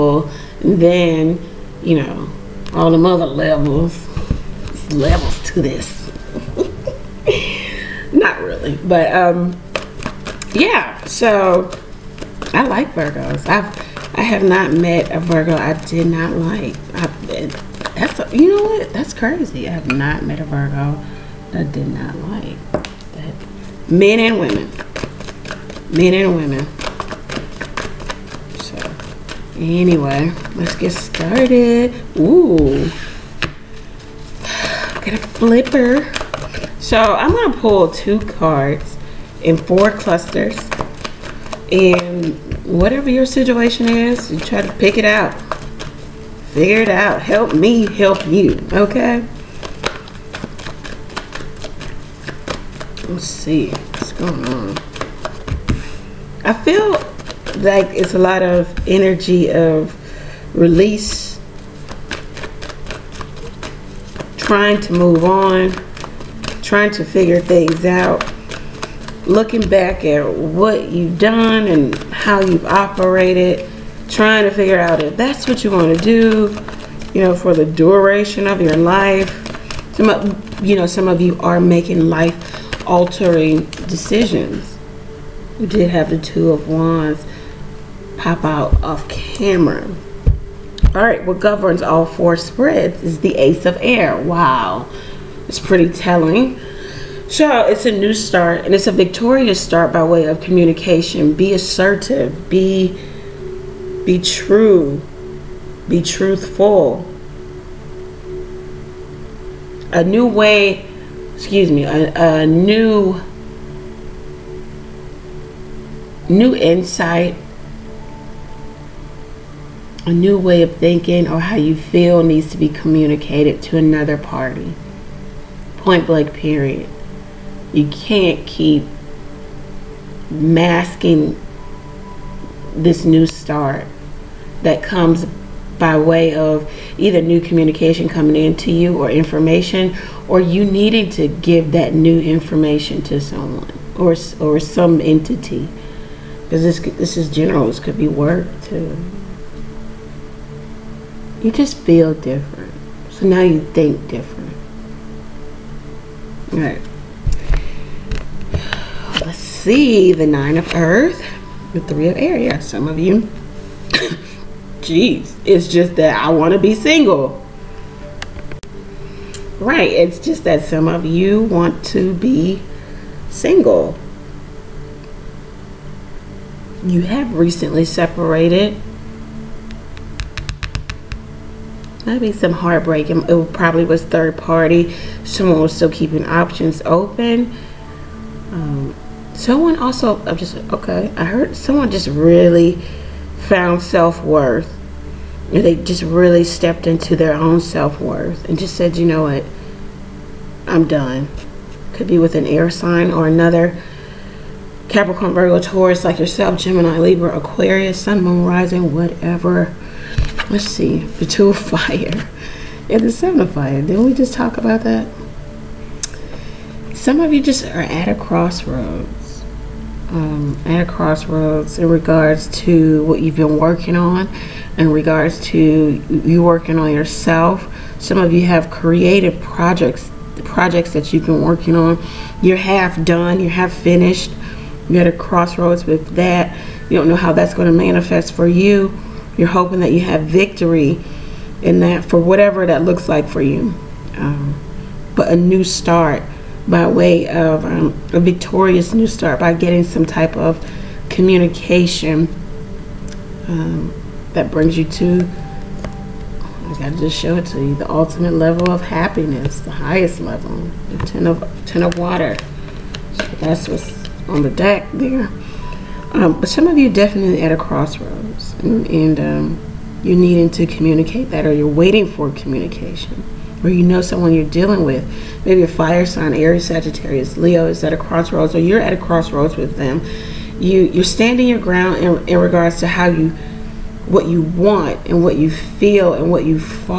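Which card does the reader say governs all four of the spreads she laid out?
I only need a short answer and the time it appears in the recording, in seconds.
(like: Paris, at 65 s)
Ace of Air, at 93 s.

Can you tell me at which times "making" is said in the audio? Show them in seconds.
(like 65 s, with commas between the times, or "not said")
81 s.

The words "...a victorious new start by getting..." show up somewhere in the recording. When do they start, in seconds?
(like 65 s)
248 s.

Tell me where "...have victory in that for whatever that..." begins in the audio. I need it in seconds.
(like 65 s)
240 s.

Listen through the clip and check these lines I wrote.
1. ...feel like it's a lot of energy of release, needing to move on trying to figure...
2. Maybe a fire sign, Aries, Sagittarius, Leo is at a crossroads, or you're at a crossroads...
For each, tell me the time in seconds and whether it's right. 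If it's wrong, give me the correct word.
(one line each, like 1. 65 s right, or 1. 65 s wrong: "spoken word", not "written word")
1. 56 s wrong: "trying", not "needing"
2. 275 s right.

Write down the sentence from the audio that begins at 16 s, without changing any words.
I, that's a, you know what?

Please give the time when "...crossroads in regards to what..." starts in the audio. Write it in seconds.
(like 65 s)
220 s.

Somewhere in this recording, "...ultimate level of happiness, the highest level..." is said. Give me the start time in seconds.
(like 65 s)
257 s.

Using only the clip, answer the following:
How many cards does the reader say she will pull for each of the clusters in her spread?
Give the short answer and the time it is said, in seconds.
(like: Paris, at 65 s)
2, at 37 s.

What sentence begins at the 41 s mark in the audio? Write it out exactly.
And whatever your situation is, you try to pick it out.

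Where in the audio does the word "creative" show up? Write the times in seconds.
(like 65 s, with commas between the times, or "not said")
228 s.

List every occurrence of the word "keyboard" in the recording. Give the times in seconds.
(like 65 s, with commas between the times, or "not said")
not said.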